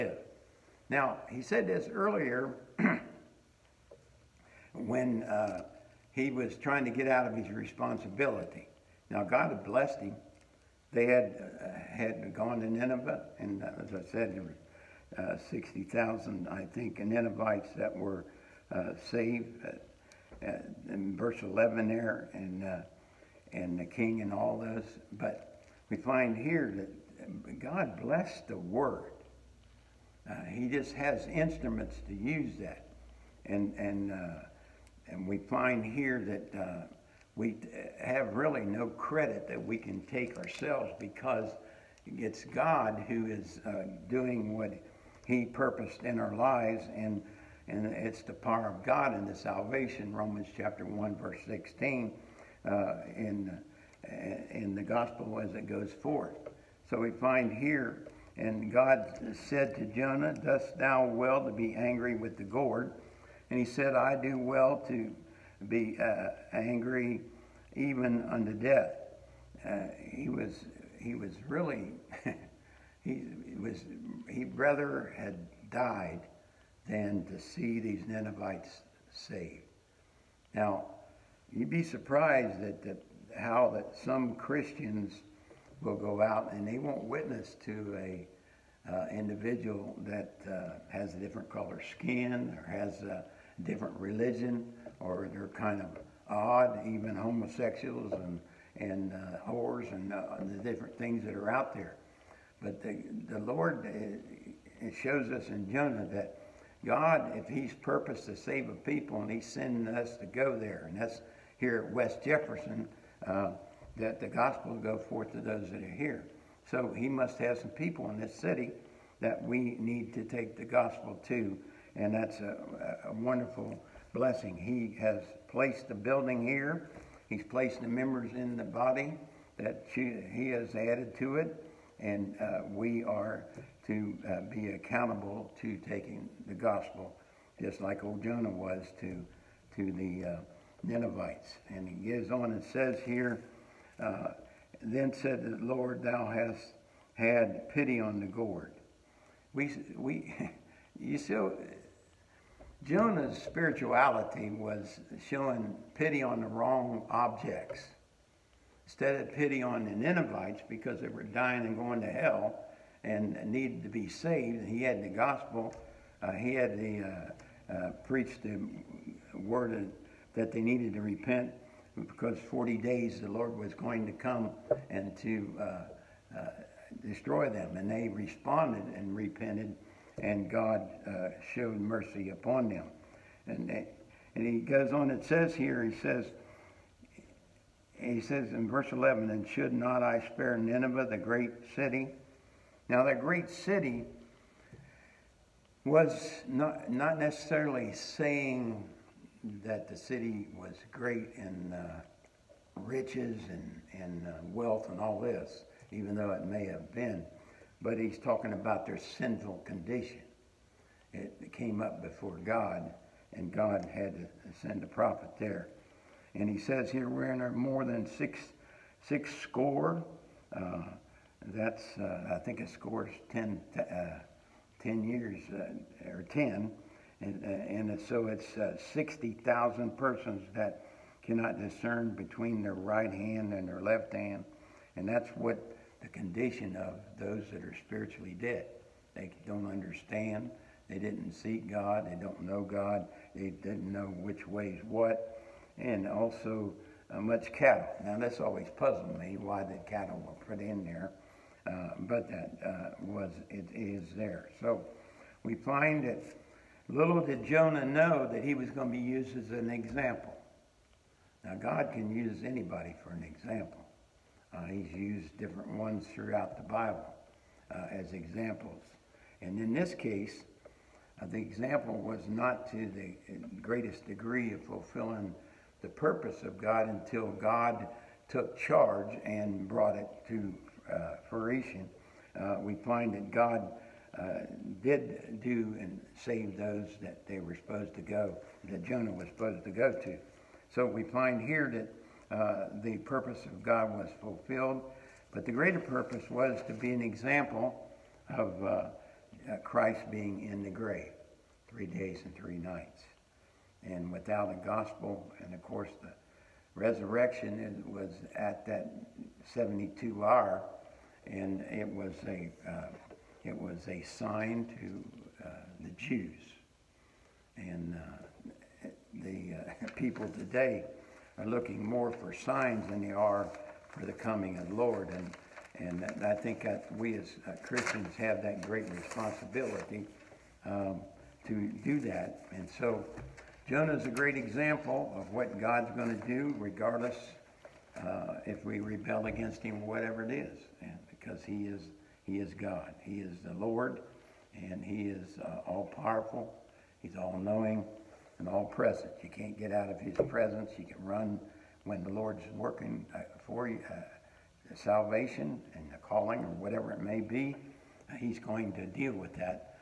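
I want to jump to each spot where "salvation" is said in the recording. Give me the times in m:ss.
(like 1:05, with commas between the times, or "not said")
0:49, 5:54.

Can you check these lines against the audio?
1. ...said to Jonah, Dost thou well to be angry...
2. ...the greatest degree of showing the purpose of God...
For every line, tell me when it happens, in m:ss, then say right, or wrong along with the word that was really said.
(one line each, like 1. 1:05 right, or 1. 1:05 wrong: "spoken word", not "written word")
1. 0:59 right
2. 4:32 wrong: "fulfilling", not "showing".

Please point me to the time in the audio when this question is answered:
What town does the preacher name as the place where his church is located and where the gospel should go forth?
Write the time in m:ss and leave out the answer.
1:51.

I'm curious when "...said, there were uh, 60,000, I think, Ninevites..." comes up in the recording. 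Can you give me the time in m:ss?
0:14.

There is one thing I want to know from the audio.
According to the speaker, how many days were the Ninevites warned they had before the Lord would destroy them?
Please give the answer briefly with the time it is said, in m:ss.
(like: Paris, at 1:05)
40, at 2:52.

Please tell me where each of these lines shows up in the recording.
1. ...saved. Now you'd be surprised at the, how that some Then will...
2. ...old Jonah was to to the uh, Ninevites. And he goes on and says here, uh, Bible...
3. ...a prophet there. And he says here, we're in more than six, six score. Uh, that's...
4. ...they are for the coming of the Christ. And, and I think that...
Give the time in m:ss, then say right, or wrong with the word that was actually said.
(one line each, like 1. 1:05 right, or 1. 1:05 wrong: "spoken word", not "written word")
1. 1:19 wrong: "Christians", not "Then"
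2. 2:18 wrong: "Then", not "Bible"
3. 3:34 right
4. 5:23 wrong: "Lord", not "Christ".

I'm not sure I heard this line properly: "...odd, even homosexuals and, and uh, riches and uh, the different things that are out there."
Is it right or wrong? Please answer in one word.
wrong.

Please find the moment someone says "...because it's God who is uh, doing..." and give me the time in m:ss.
0:40.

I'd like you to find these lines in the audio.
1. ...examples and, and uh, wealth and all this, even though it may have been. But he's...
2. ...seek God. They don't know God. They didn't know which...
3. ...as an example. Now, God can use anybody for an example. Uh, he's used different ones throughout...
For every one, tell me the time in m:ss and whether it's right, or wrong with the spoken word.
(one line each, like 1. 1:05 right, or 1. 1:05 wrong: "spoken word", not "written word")
1. 3:22 wrong: "riches", not "examples"
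2. 4:01 right
3. 4:19 right.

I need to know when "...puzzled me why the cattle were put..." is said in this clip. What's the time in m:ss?
4:08.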